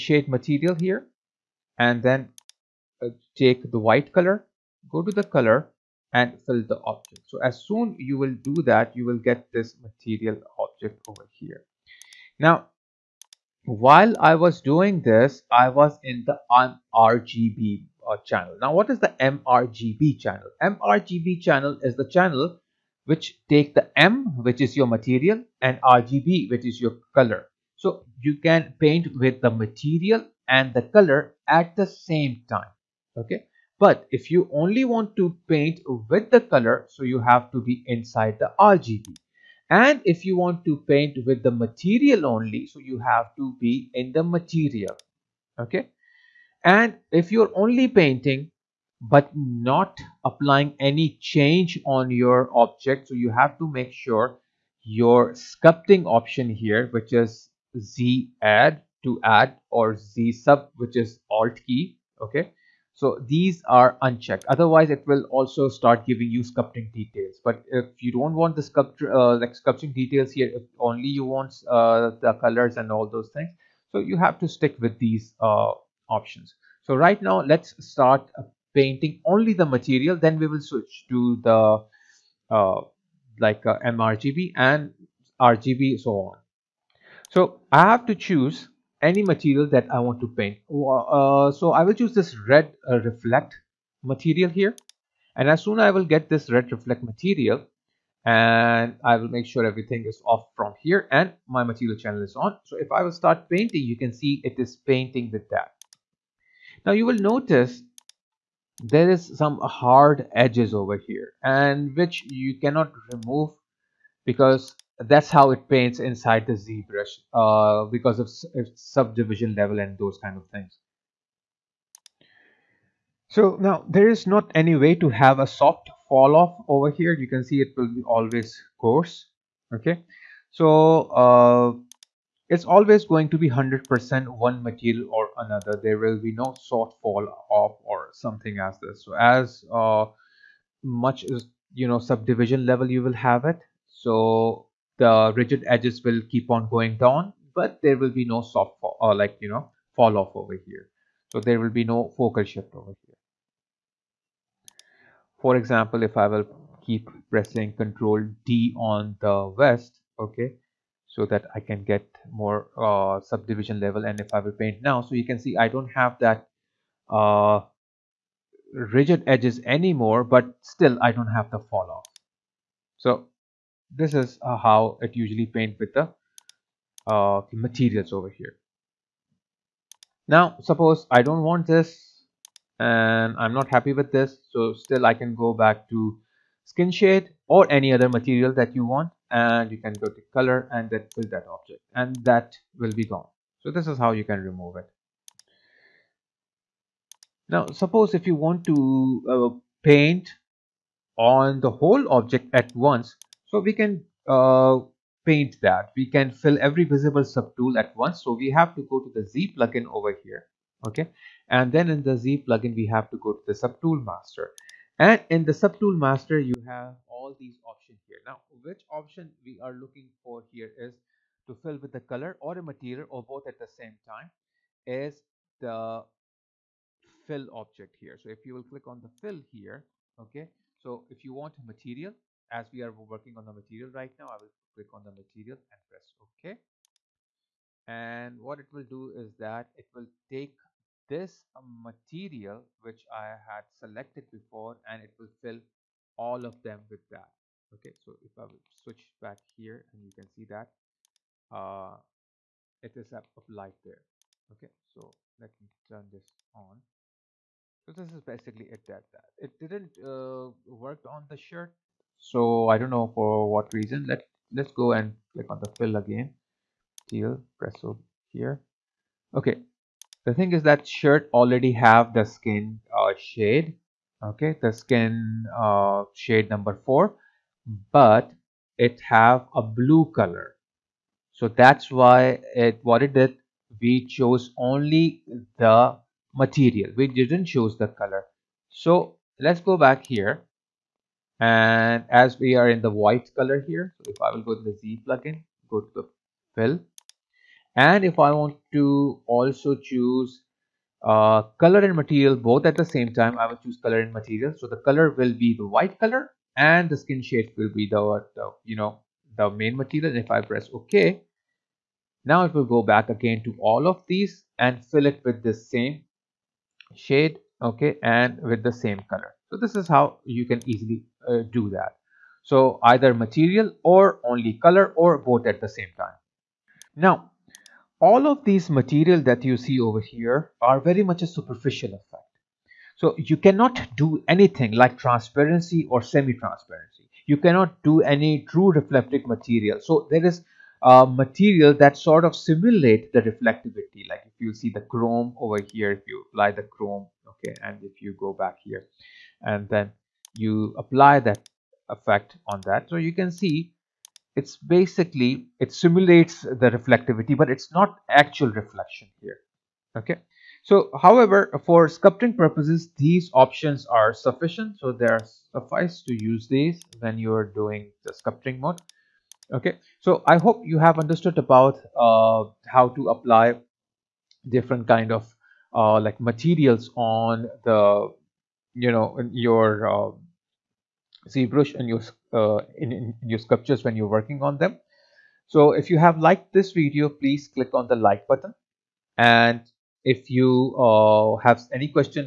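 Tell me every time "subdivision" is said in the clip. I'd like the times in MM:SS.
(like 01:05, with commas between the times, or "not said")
01:58, 02:21, 02:43.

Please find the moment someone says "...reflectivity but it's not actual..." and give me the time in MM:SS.
05:56.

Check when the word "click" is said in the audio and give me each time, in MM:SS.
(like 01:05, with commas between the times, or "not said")
03:48, 03:54, 04:25, 06:27.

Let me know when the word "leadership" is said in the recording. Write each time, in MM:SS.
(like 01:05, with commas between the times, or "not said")
not said.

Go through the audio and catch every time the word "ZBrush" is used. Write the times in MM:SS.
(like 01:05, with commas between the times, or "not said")
01:56, 06:21.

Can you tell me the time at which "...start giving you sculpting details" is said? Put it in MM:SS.
01:05.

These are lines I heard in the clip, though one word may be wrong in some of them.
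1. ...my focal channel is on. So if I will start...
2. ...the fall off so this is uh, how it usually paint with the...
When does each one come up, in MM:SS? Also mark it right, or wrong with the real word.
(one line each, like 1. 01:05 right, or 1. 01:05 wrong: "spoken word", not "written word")
1. 01:41 wrong: "material", not "focal"
2. 02:51 right.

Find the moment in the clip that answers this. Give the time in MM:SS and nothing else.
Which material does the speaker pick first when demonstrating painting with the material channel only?
01:32.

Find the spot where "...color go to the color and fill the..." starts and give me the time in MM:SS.
00:04.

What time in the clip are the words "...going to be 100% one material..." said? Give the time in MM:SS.
02:13.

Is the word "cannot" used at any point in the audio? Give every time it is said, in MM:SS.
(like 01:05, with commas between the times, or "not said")
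01:52, 05:33, 05:37.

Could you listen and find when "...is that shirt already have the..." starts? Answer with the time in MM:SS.
04:30.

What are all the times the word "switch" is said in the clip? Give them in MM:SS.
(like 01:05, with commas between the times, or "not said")
01:20, 04:08.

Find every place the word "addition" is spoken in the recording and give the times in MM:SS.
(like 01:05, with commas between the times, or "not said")
not said.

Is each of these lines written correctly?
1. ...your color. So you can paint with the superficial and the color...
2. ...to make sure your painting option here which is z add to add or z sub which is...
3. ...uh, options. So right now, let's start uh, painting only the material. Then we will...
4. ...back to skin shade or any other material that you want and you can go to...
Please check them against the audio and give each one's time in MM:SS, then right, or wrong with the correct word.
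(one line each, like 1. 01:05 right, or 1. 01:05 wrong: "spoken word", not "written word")
1. 00:26 wrong: "material", not "superficial"
2. 00:53 wrong: "sculpting", not "painting"
3. 01:15 right
4. 03:05 right.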